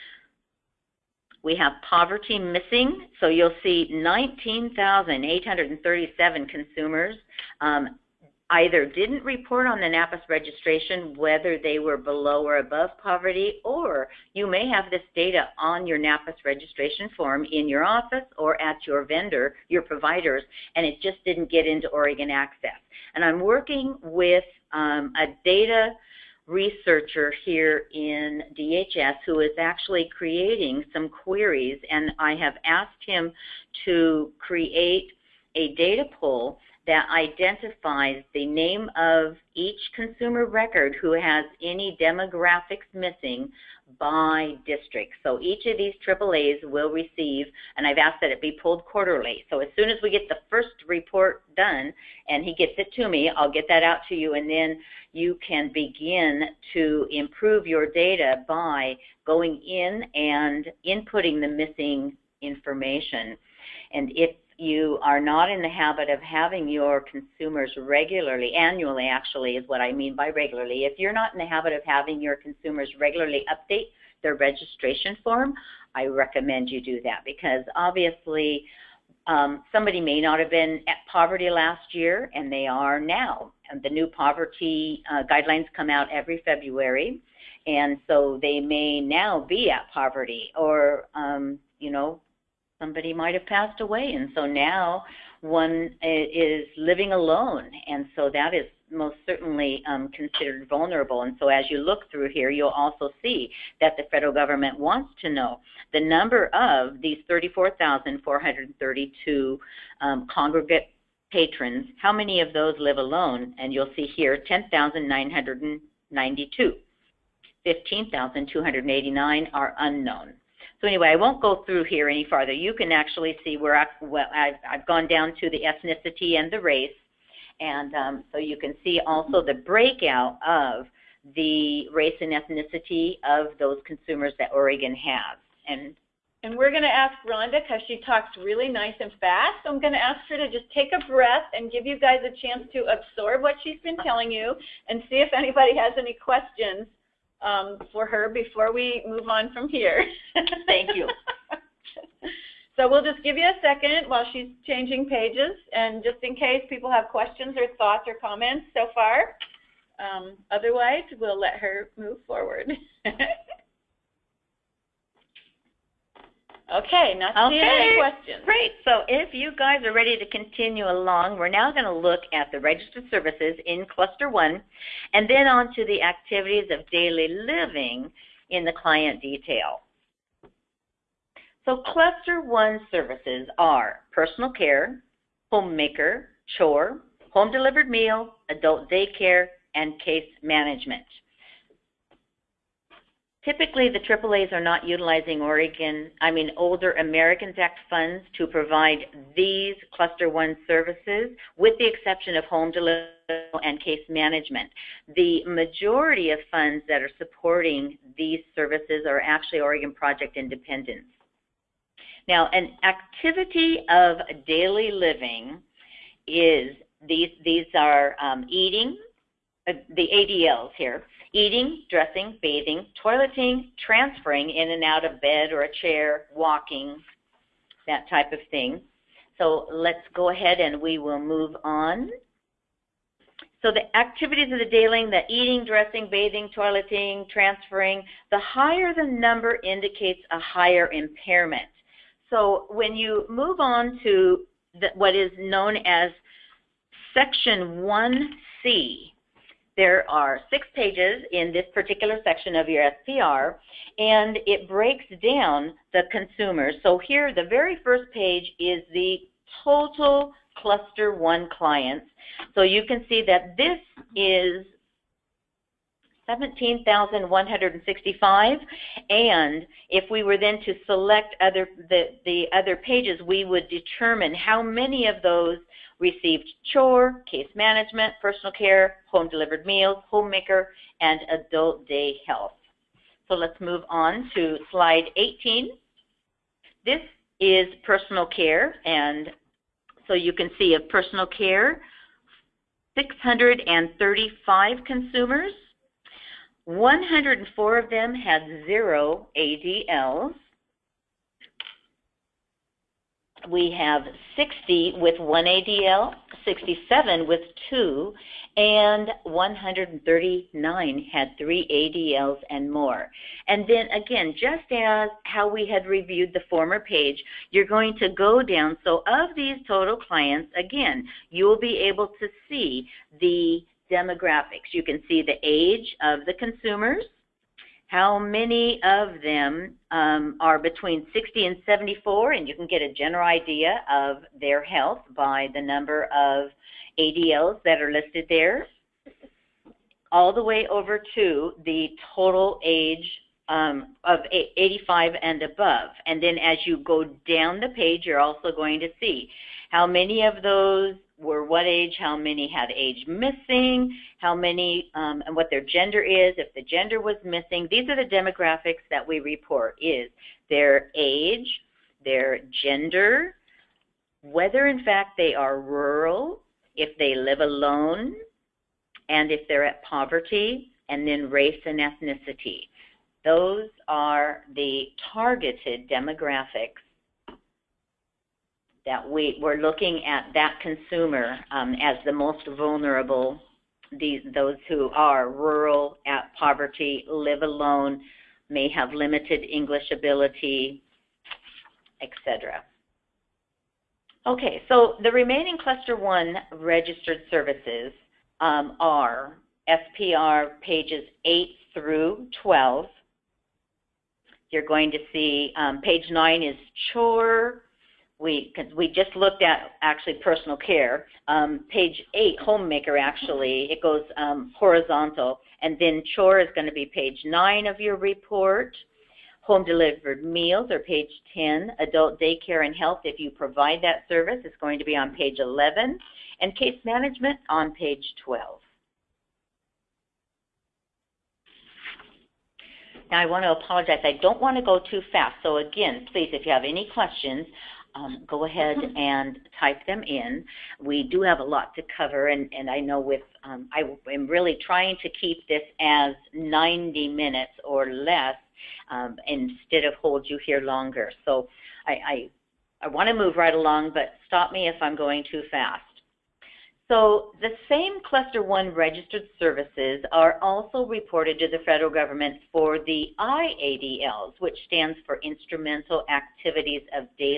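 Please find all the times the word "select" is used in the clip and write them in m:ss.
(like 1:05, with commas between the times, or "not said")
4:30.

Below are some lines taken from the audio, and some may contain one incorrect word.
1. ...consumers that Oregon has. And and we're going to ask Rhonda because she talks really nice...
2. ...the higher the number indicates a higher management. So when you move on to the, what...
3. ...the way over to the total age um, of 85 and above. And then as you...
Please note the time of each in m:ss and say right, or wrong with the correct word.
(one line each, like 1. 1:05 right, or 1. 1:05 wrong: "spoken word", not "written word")
1. 2:13 right
2. 3:58 wrong: "impairment", not "management"
3. 5:40 right.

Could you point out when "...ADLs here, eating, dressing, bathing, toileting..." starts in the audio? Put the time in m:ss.
3:40.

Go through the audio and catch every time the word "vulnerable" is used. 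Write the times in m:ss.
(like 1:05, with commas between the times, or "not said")
1:40, 6:22.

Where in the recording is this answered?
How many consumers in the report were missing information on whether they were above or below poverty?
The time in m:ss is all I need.
0:03.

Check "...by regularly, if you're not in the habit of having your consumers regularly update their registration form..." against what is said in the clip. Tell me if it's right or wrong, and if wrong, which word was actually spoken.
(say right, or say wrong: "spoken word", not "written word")
right.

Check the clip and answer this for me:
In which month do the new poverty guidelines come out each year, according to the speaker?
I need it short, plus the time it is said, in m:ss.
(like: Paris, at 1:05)
February, at 1:26.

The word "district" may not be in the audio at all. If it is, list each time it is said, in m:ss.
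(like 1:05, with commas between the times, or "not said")
0:44.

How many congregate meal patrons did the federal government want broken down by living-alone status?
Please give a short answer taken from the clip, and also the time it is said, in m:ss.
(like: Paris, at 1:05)
34,432, at 1:47.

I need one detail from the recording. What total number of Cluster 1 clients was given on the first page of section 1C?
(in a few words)
17,165.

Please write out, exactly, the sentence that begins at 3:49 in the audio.
So let's go ahead and we will move on.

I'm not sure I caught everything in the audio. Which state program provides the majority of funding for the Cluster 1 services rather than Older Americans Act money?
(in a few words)
Oregon Project Independence.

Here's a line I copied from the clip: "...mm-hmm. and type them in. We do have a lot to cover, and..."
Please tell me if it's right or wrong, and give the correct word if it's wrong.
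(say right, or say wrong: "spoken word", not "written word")
right.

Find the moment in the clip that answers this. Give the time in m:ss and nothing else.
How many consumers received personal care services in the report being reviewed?
4:52.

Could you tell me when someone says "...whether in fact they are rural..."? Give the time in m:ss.
6:04.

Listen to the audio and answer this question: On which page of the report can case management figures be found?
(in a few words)
page 12.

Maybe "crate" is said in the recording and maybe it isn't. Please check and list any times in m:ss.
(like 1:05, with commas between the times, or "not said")
not said.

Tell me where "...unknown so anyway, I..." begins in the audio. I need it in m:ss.
1:59.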